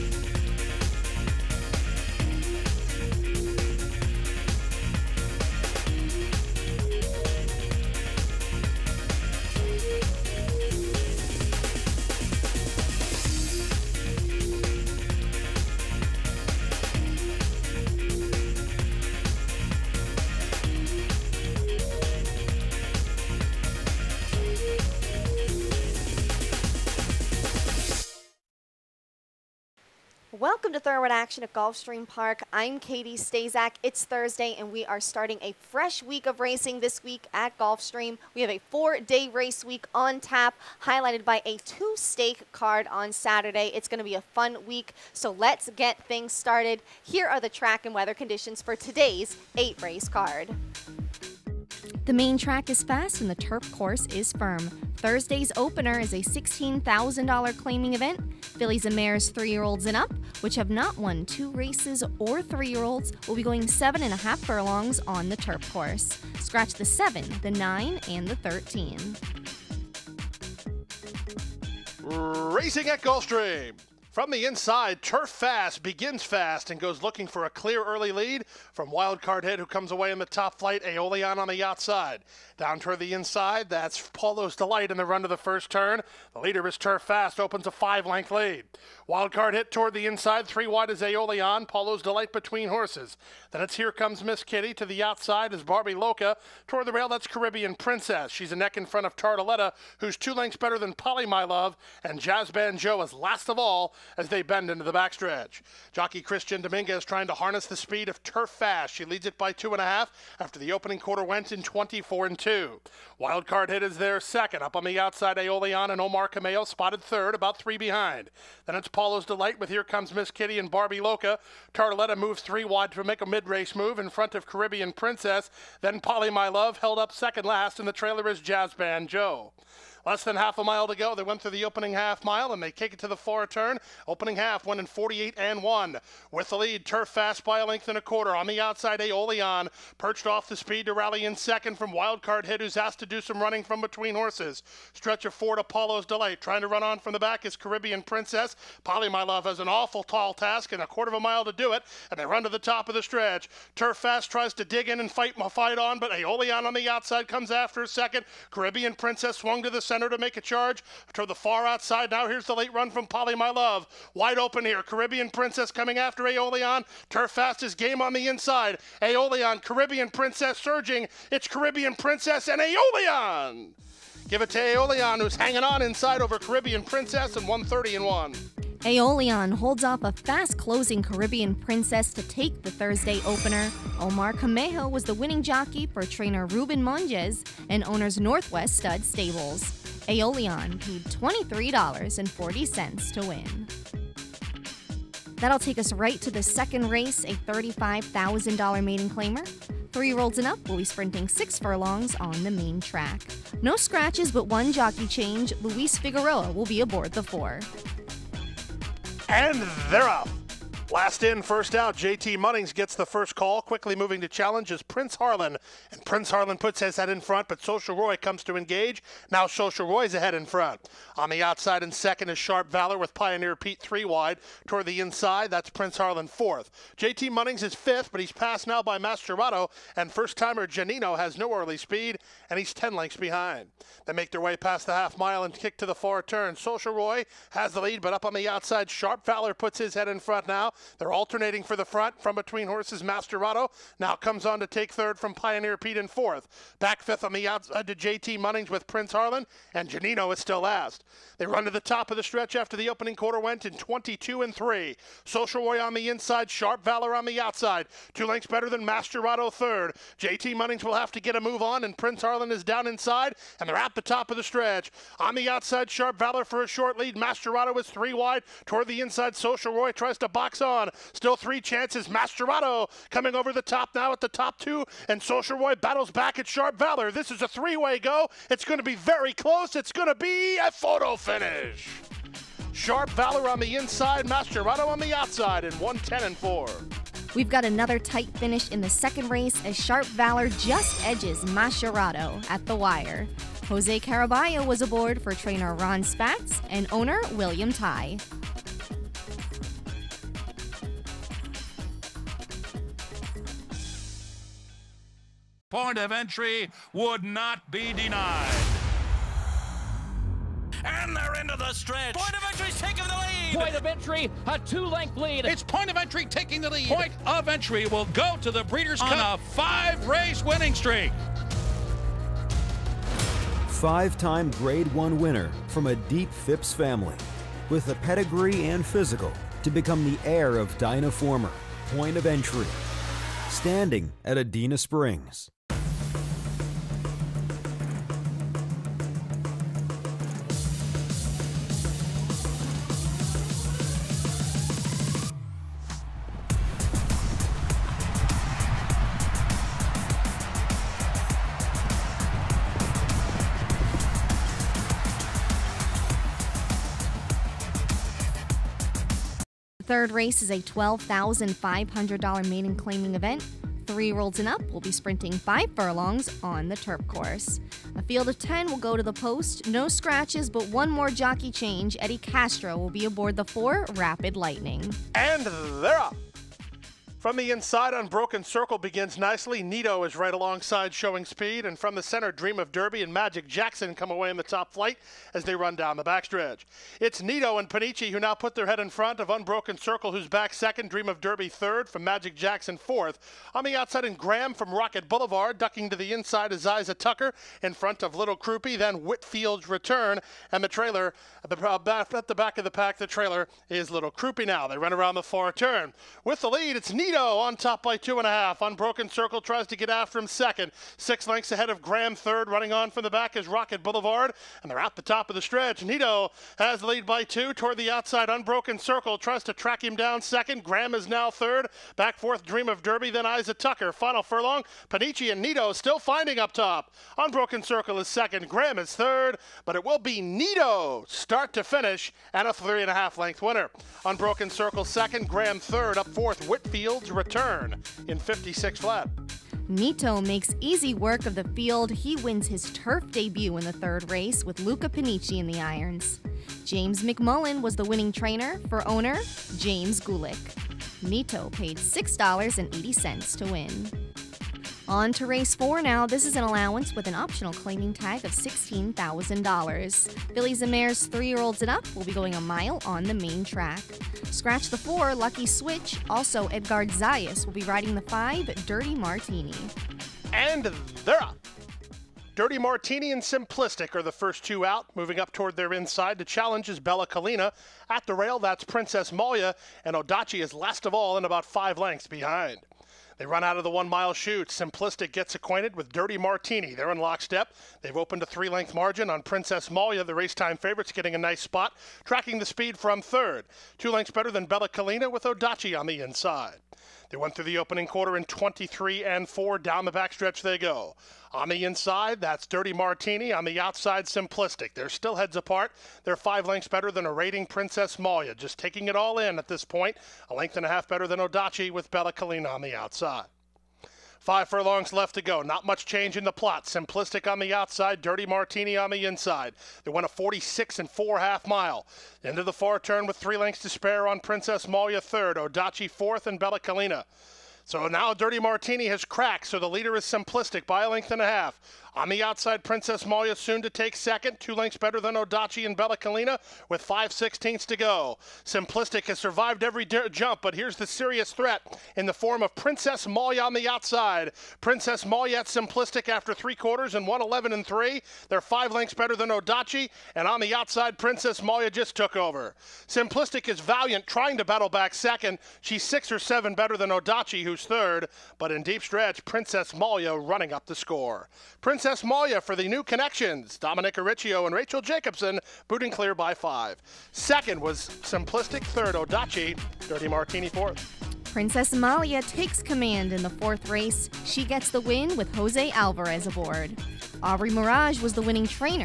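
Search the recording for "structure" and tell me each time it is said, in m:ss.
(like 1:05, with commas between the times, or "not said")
not said.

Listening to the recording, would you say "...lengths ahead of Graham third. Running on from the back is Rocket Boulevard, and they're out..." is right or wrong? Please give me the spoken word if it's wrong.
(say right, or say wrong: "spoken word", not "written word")
right.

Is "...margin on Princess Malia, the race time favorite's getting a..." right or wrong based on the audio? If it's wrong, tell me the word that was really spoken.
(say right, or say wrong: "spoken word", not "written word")
right.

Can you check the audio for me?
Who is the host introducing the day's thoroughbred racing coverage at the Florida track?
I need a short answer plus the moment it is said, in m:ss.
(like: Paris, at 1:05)
Katie Stazak, at 0:32.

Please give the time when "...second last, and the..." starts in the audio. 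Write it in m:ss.
2:07.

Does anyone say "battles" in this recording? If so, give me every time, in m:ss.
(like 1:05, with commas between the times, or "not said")
4:35, 9:14.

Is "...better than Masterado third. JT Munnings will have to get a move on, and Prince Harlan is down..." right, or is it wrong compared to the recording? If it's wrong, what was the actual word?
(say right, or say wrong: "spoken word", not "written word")
right.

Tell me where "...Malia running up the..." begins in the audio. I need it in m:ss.
9:19.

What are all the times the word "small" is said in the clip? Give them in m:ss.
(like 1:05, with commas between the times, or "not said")
not said.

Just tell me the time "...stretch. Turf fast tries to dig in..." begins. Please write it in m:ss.
2:33.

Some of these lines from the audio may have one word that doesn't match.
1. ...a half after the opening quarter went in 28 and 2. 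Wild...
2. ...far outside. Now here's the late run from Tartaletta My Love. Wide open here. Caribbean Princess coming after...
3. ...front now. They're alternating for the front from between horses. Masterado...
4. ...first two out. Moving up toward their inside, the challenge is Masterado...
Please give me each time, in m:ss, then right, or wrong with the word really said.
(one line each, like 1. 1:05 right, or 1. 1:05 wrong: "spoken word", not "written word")
1. 1:49 wrong: "24", not "28"
2. 2:41 wrong: "Polly", not "Tartaletta"
3. 4:00 right
4. 7:54 wrong: "Bella", not "Masterado".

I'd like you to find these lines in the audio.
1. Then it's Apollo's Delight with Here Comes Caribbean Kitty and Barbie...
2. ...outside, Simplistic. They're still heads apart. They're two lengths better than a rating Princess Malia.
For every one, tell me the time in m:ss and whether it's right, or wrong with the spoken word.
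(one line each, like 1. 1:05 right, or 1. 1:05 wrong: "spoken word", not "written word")
1. 1:58 wrong: "Miss", not "Caribbean"
2. 8:23 wrong: "five", not "two".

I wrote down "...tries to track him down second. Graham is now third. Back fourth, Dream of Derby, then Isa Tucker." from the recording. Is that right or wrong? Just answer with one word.
right.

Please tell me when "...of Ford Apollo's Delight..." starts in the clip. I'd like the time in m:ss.
2:25.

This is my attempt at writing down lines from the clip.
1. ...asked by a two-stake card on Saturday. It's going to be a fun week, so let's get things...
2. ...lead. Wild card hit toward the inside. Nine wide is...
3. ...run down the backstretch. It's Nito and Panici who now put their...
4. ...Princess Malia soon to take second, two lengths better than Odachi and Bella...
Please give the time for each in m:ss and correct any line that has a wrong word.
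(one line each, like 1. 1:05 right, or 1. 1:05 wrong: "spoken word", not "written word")
1. 0:40 wrong: "highlighted", not "asked"
2. 1:28 wrong: "Three", not "Nine"
3. 6:25 right
4. 8:52 right.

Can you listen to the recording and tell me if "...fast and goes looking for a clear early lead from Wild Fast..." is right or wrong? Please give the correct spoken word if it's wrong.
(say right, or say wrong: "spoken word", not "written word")
wrong: "Card", not "Fast".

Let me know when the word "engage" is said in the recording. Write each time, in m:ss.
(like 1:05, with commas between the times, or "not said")
3:38.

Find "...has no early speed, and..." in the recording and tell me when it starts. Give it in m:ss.
3:51.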